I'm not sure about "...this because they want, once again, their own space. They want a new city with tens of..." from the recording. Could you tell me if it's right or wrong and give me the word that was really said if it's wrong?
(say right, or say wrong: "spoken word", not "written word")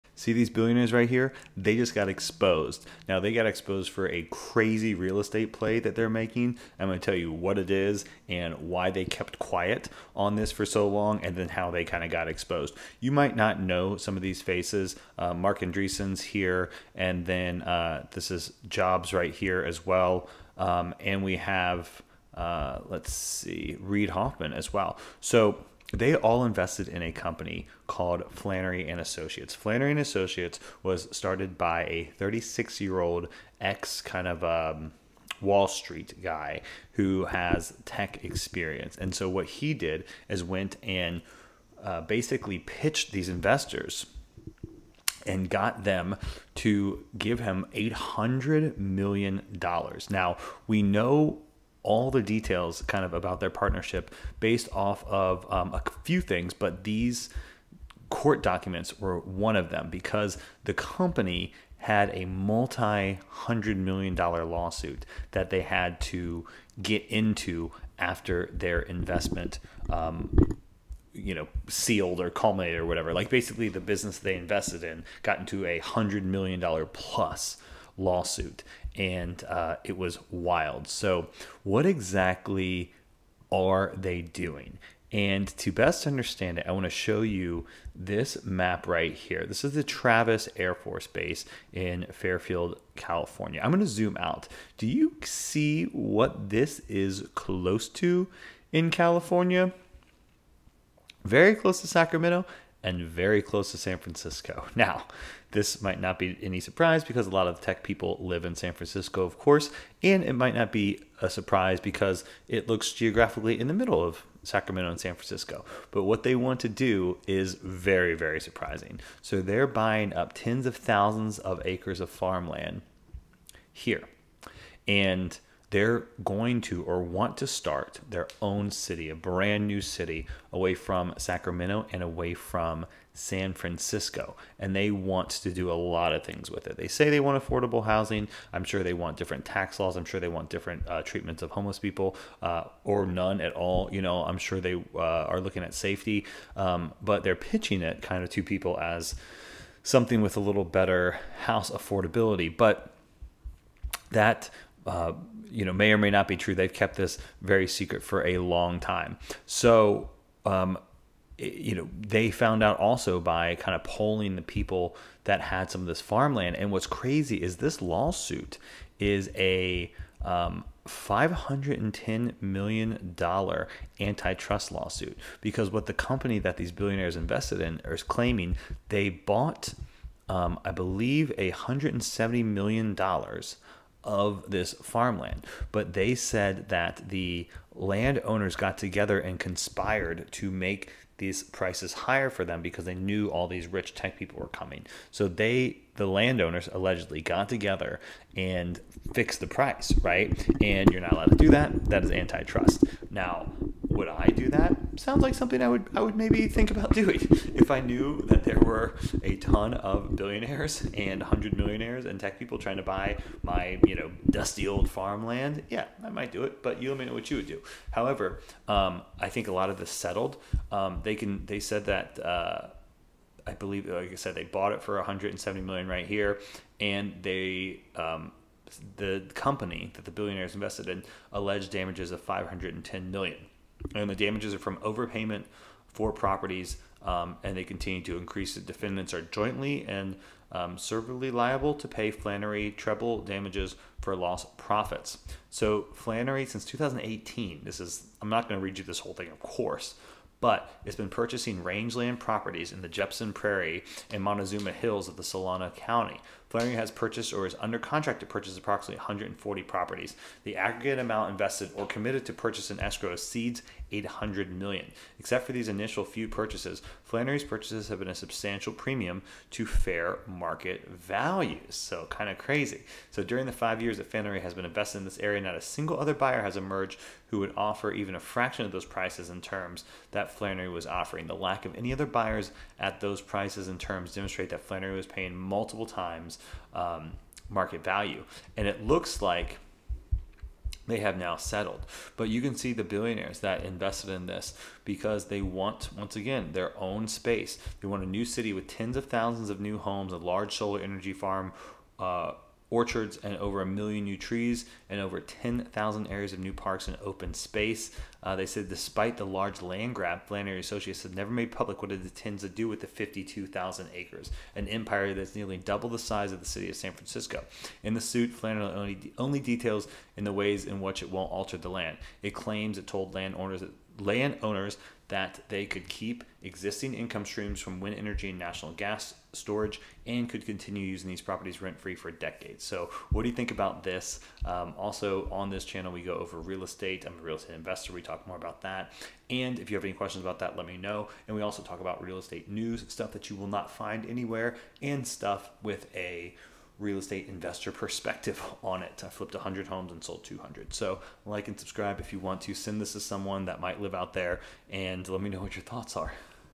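right.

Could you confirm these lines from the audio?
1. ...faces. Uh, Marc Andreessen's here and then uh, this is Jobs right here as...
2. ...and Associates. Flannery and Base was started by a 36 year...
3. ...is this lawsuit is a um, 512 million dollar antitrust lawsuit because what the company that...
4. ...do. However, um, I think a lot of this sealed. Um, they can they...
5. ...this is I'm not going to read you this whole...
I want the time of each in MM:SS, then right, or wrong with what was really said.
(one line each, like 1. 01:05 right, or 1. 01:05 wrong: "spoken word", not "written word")
1. 00:14 right
2. 00:28 wrong: "Associates", not "Base"
3. 02:47 wrong: "510", not "512"
4. 03:37 wrong: "settled", not "sealed"
5. 04:07 right.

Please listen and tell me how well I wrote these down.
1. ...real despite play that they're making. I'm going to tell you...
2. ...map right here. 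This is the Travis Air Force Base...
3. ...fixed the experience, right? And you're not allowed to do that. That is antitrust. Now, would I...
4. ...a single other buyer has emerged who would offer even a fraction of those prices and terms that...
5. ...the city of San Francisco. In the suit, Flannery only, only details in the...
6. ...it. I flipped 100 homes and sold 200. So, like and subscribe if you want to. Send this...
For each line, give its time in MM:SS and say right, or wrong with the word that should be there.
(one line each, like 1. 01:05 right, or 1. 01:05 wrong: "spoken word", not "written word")
1. 00:04 wrong: "estate", not "despite"
2. 01:28 right
3. 03:19 wrong: "price", not "experience"
4. 04:35 right
5. 05:16 right
6. 05:48 right.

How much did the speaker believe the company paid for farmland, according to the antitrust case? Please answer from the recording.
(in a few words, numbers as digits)
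$170 million.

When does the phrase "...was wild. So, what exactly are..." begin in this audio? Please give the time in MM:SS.
01:19.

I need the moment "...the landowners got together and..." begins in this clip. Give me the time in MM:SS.
03:07.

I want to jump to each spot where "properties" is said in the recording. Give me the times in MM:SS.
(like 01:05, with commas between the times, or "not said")
03:56, 04:12, 04:19, 05:31.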